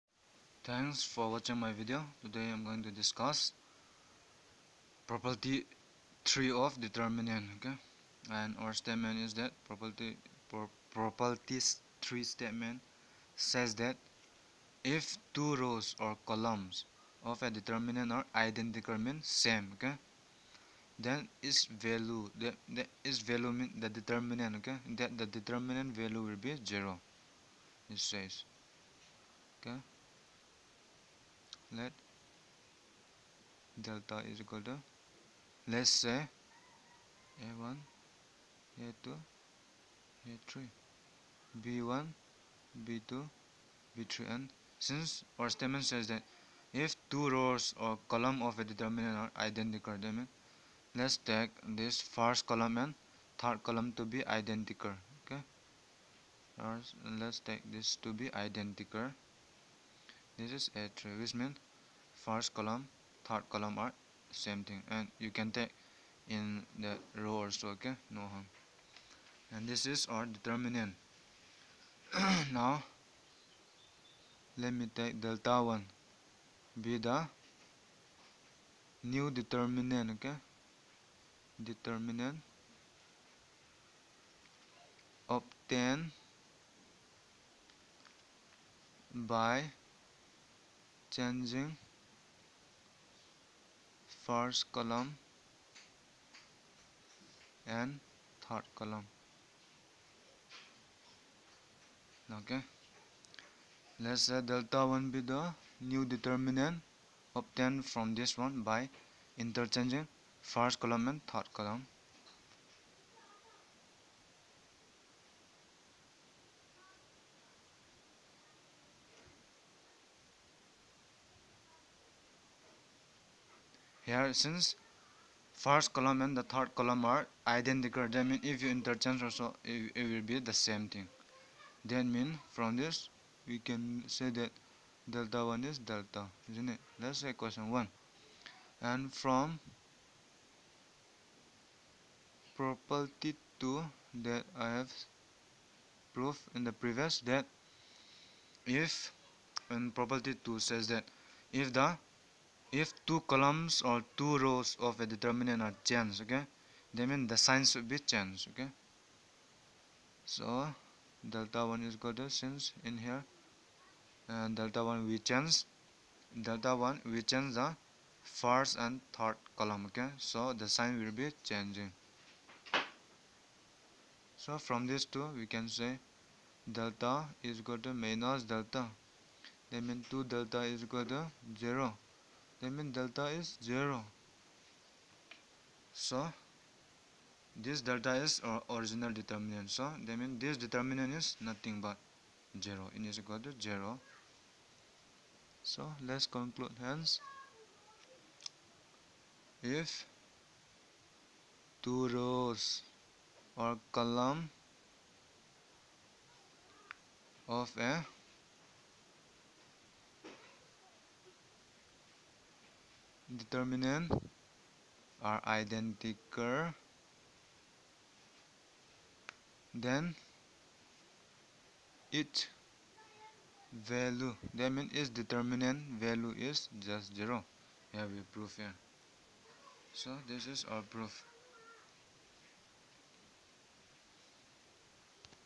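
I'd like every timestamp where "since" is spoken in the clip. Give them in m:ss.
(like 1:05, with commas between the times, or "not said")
0:44, 2:04, 2:42.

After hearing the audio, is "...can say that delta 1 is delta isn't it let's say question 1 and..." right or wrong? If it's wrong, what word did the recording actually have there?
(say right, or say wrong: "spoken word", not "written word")
right.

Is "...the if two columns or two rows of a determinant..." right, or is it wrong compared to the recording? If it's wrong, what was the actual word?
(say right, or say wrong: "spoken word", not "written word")
right.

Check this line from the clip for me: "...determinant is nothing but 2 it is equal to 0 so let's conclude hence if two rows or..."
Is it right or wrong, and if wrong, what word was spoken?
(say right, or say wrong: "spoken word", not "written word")
wrong: "0", not "2".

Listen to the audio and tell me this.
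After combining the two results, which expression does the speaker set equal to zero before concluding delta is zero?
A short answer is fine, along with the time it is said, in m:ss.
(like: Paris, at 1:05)
2 delta, at 3:00.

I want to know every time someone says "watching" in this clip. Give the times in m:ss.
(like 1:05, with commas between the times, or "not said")
0:01.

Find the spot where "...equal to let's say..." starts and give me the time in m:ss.
0:34.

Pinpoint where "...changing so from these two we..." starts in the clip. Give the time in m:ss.
2:51.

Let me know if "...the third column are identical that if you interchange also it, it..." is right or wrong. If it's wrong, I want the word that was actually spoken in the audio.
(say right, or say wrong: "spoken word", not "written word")
right.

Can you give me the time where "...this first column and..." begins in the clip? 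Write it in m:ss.
0:51.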